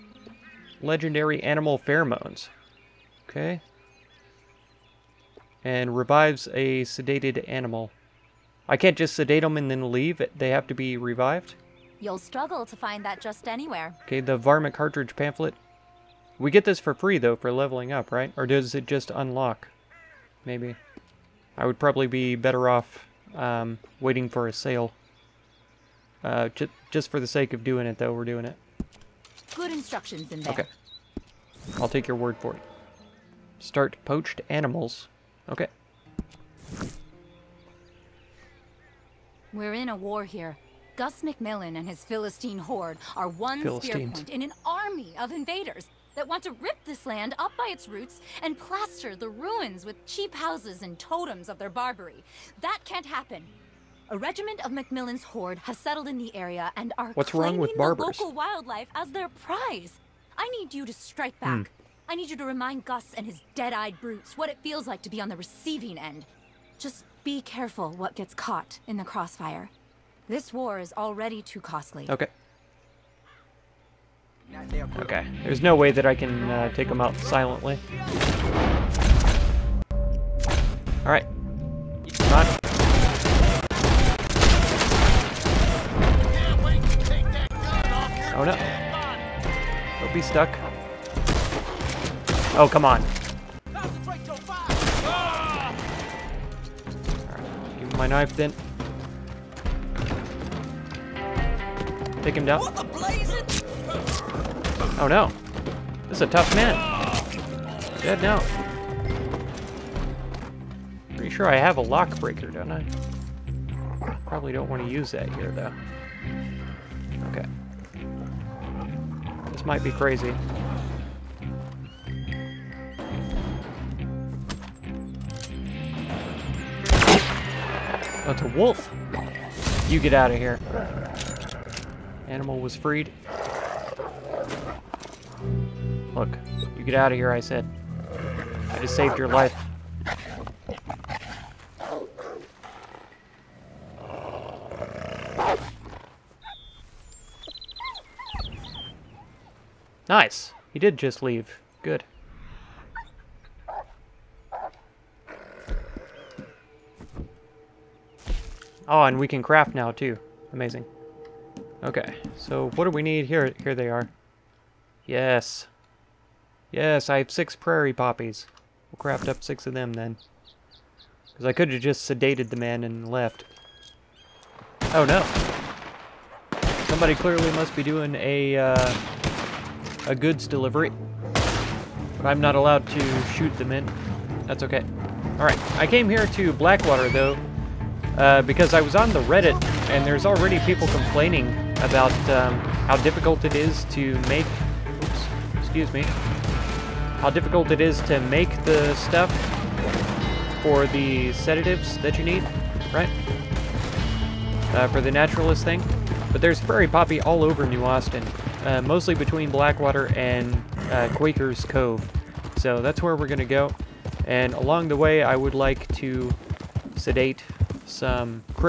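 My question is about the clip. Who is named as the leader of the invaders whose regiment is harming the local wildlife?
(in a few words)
Gus McMillan.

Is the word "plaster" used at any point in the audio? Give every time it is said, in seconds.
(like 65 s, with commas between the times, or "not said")
48 s.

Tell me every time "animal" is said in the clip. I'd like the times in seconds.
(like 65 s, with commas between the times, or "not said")
1 s, 7 s, 34 s, 132 s.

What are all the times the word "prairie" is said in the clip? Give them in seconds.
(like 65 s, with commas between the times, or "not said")
167 s, 206 s.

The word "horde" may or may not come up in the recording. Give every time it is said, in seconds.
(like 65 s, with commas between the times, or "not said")
42 s, 55 s.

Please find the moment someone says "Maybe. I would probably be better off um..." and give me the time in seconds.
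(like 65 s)
20 s.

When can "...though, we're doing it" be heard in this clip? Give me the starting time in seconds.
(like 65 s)
27 s.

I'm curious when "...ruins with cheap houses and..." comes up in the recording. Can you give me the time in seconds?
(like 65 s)
49 s.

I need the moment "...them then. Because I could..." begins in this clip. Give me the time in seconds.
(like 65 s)
169 s.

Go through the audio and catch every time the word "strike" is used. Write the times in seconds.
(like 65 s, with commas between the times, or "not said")
60 s.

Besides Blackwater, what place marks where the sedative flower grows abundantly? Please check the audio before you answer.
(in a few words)
Quaker's Cove.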